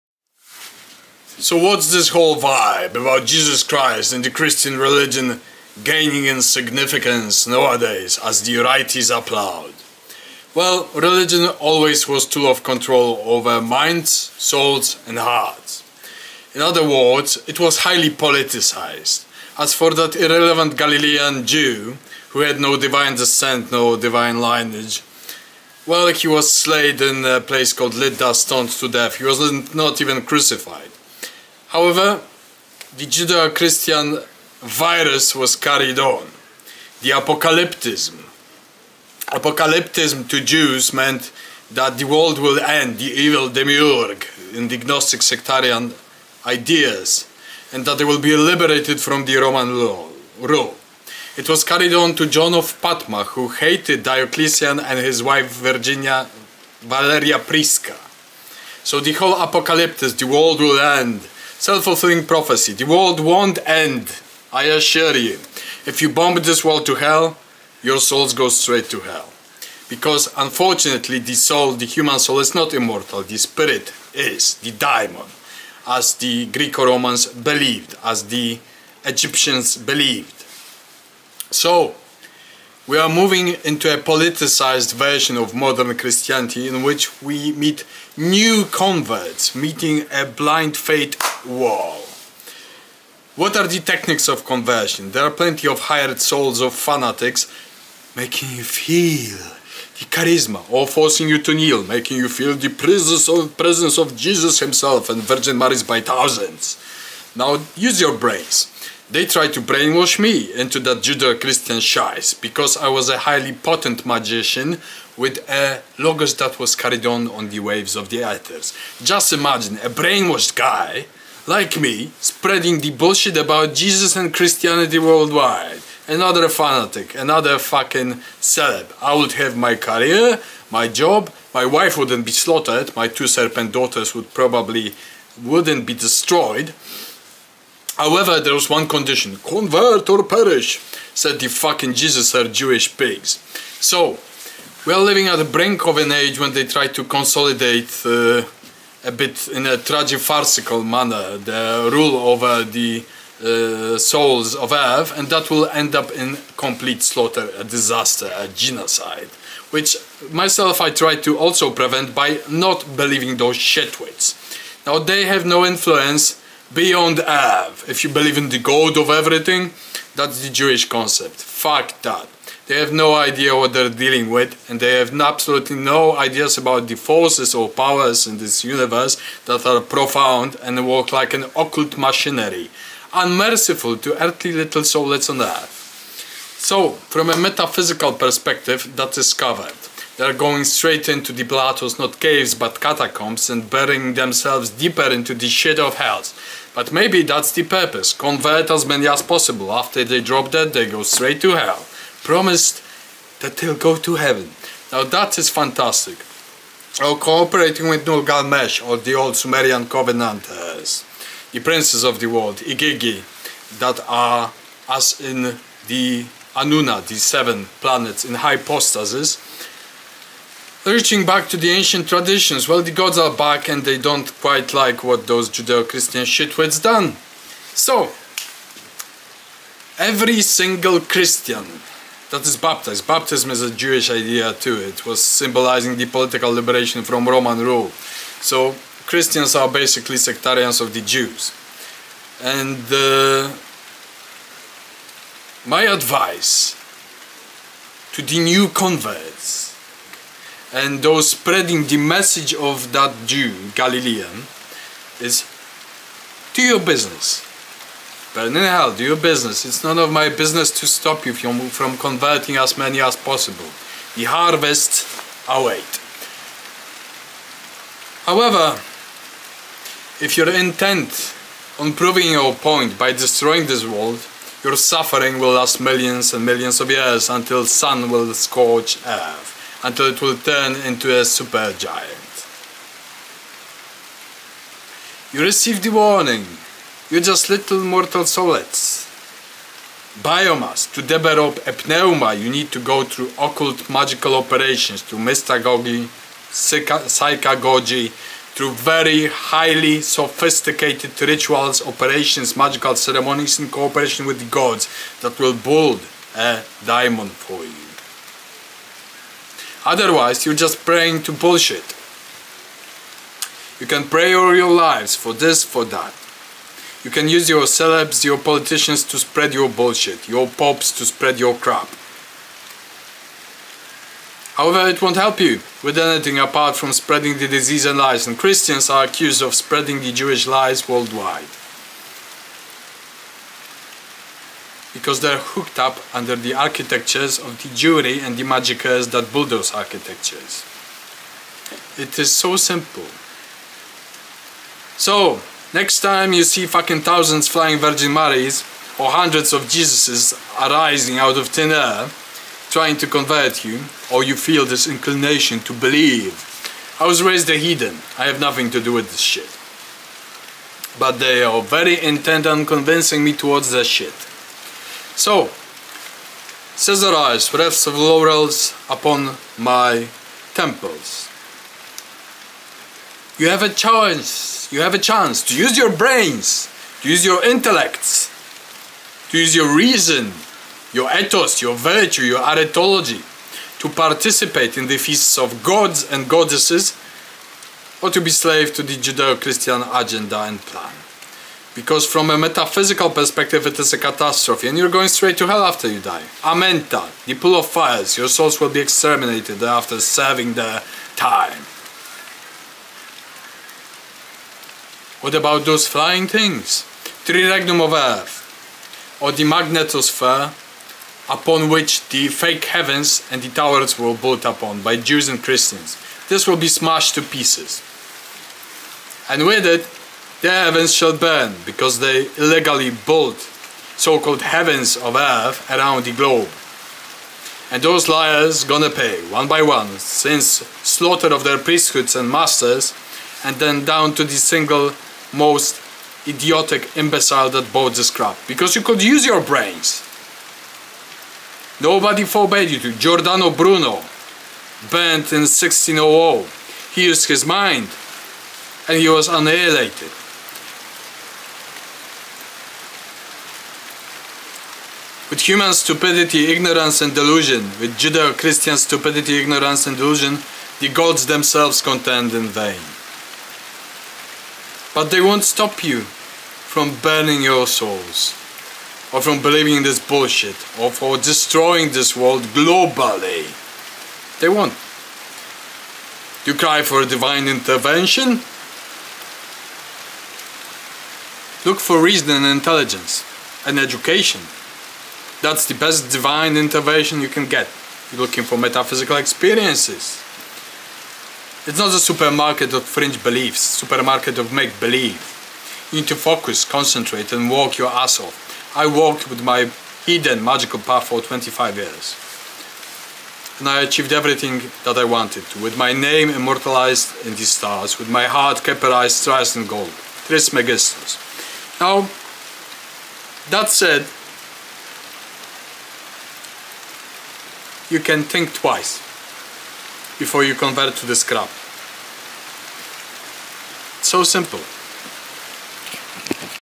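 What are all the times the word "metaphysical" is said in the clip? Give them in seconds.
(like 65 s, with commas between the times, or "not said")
187 s, 392 s, 488 s.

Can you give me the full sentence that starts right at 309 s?
Otherwise, you're just praying to bullshit.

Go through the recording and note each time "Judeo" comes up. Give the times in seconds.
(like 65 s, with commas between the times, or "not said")
33 s, 110 s, 225 s, 388 s, 457 s.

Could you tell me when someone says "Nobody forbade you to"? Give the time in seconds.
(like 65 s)
441 s.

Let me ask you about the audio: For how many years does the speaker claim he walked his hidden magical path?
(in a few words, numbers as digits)
25.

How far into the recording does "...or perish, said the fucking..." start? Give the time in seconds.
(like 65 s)
140 s.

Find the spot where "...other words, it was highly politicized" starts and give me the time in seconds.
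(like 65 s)
16 s.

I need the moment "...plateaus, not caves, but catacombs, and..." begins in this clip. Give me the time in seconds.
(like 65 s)
191 s.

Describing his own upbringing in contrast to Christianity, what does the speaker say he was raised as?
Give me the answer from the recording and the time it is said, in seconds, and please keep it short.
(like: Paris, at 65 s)
heathen, at 357 s.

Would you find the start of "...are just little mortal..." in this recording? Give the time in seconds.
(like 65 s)
287 s.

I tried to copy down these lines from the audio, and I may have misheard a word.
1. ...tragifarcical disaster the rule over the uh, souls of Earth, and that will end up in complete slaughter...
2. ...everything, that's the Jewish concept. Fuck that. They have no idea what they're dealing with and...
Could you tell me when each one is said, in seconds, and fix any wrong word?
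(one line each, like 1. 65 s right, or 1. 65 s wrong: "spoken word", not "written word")
1. 149 s wrong: "manner", not "disaster"
2. 169 s right.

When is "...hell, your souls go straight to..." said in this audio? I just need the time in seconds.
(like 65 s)
66 s.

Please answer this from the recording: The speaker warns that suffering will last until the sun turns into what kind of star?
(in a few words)
supergiant.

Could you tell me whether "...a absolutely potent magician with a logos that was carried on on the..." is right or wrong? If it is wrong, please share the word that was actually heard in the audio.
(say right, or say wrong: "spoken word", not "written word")
wrong: "highly", not "absolutely".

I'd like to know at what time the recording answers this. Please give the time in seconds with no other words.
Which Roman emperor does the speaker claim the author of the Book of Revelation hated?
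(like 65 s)
54 s.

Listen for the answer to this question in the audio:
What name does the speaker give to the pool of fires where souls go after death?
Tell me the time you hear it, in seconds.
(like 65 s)
396 s.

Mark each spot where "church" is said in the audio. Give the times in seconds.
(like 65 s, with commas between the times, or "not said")
not said.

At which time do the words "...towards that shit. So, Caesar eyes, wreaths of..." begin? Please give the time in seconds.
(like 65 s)
363 s.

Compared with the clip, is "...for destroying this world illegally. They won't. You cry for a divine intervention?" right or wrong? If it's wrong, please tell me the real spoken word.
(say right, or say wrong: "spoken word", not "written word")
wrong: "globally", not "illegally".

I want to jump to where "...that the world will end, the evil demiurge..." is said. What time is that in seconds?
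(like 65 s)
41 s.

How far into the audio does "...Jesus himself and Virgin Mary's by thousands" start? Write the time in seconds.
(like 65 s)
104 s.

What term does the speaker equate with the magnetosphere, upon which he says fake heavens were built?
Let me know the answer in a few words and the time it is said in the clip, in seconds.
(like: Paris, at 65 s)
Triregnum of Earth, at 407 s.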